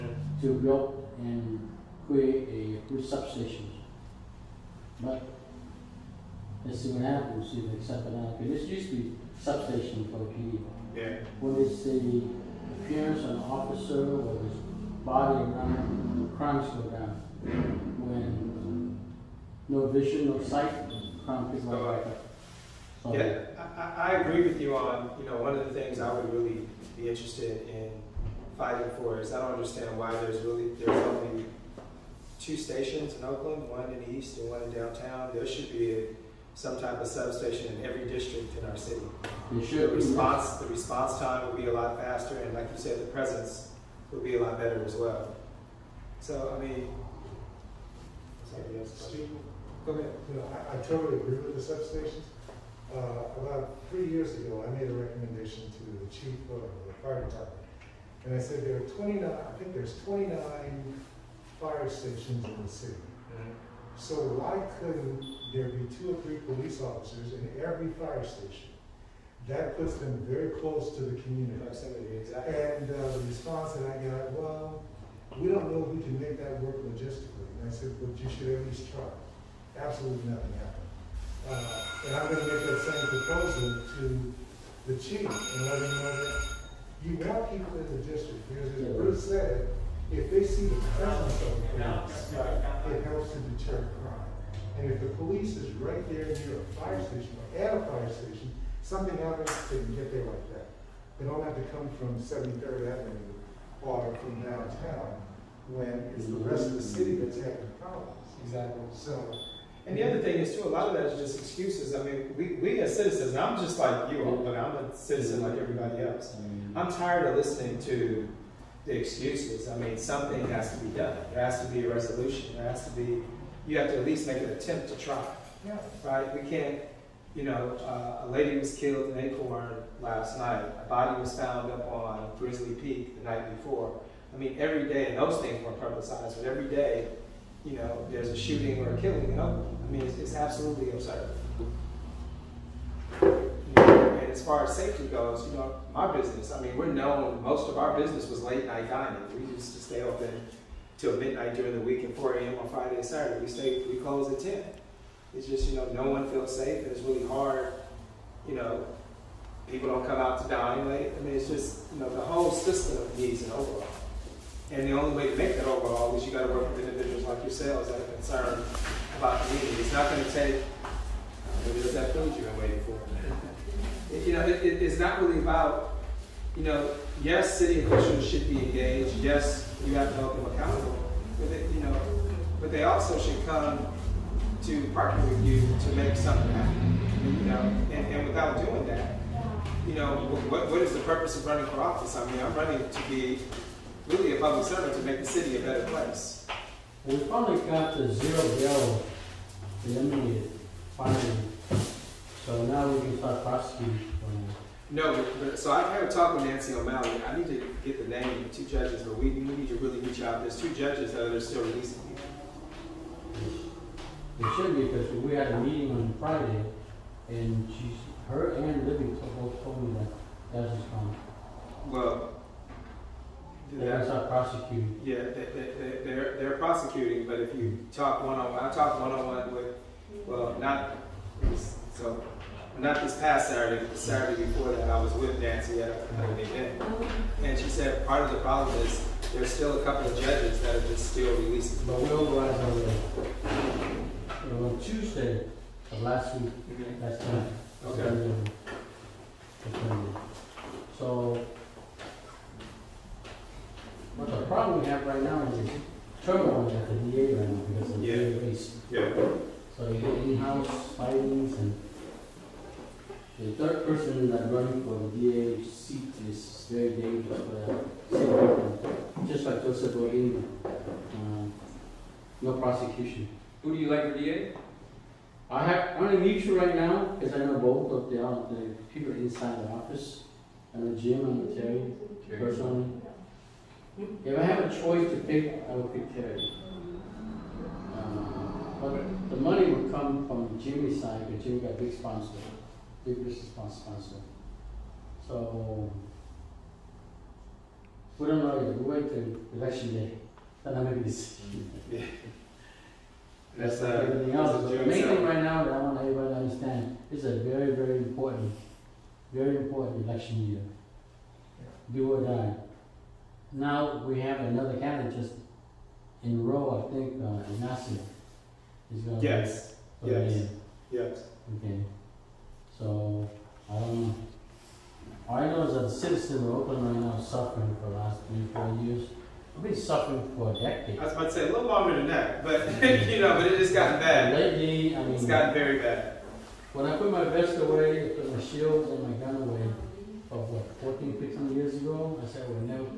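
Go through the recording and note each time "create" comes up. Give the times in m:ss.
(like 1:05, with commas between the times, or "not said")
0:02.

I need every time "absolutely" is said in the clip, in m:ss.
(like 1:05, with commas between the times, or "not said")
1:19, 2:20.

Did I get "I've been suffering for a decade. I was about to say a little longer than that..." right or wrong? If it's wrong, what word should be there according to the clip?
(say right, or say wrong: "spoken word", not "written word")
right.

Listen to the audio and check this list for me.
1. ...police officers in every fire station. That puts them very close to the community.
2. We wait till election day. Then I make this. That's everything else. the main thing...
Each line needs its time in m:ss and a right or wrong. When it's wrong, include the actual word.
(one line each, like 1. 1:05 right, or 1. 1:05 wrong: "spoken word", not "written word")
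1. 1:06 right
2. 4:58 right.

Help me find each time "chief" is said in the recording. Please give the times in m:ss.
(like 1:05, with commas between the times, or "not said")
0:56, 1:24.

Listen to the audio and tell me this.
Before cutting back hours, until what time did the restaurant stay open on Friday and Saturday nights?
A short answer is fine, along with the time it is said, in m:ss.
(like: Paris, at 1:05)
4 a.m., at 2:32.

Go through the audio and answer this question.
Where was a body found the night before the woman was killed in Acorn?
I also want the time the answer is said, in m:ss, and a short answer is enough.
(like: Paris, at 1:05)
Grizzly Peak, at 2:12.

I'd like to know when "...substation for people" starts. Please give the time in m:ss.
0:09.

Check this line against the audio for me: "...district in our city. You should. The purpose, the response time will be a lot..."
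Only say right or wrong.
wrong.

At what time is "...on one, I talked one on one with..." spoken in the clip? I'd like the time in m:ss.
3:48.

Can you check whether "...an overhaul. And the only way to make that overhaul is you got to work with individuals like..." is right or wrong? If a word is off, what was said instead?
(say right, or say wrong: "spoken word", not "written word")
right.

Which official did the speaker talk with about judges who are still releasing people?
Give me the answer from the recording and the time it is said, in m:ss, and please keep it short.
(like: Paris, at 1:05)
Nancy O'Malley, at 3:26.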